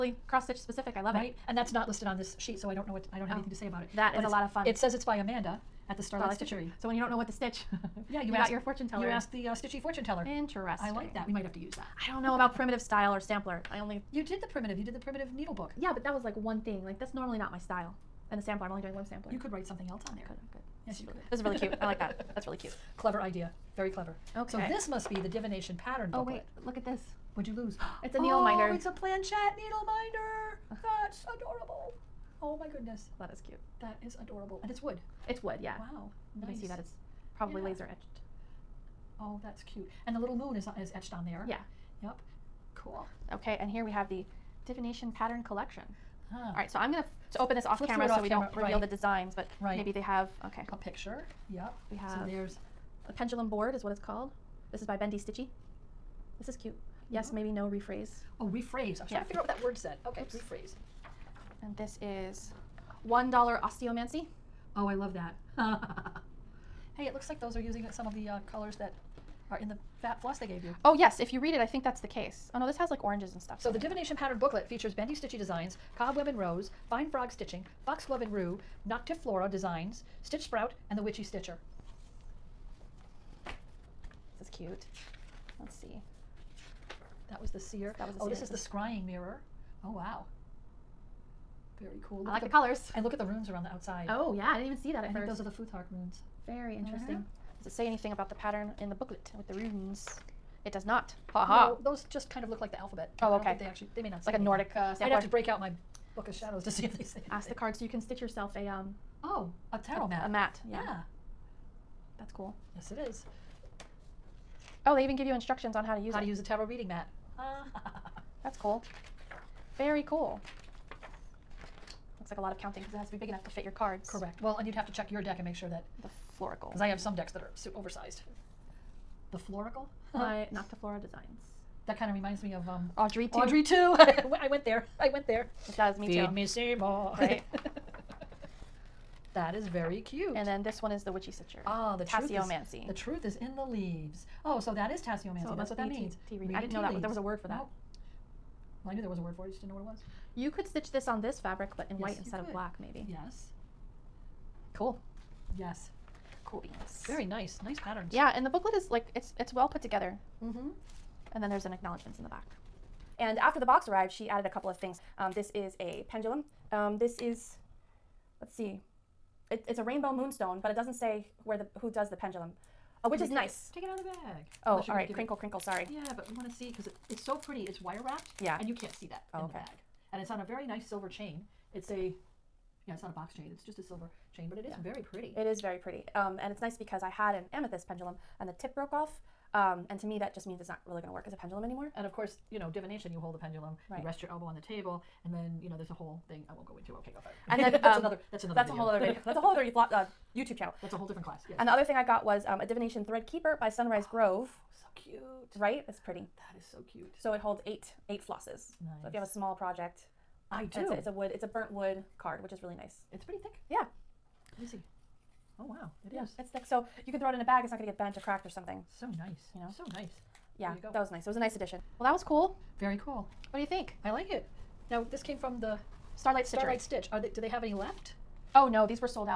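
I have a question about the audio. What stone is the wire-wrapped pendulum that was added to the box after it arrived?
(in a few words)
Rainbow moonstone.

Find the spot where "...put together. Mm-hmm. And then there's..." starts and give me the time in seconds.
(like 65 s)
159 s.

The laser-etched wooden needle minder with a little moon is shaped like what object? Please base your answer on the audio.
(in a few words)
Planchette.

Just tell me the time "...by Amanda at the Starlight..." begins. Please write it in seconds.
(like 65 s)
5 s.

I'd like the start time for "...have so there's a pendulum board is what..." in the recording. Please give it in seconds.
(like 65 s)
51 s.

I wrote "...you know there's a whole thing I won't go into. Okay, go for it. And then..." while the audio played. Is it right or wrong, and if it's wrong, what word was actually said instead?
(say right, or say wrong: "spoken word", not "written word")
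right.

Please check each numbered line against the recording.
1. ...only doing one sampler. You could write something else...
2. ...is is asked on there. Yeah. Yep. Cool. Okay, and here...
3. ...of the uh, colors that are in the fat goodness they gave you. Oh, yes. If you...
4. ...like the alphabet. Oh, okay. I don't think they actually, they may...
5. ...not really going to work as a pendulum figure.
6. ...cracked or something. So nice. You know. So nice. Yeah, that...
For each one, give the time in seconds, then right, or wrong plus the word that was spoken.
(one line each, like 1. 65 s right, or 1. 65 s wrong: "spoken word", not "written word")
1. 18 s right
2. 40 s wrong: "etched", not "asked"
3. 68 s wrong: "floss", not "goodness"
4. 102 s right
5. 190 s wrong: "anymore", not "figure"
6. 218 s right.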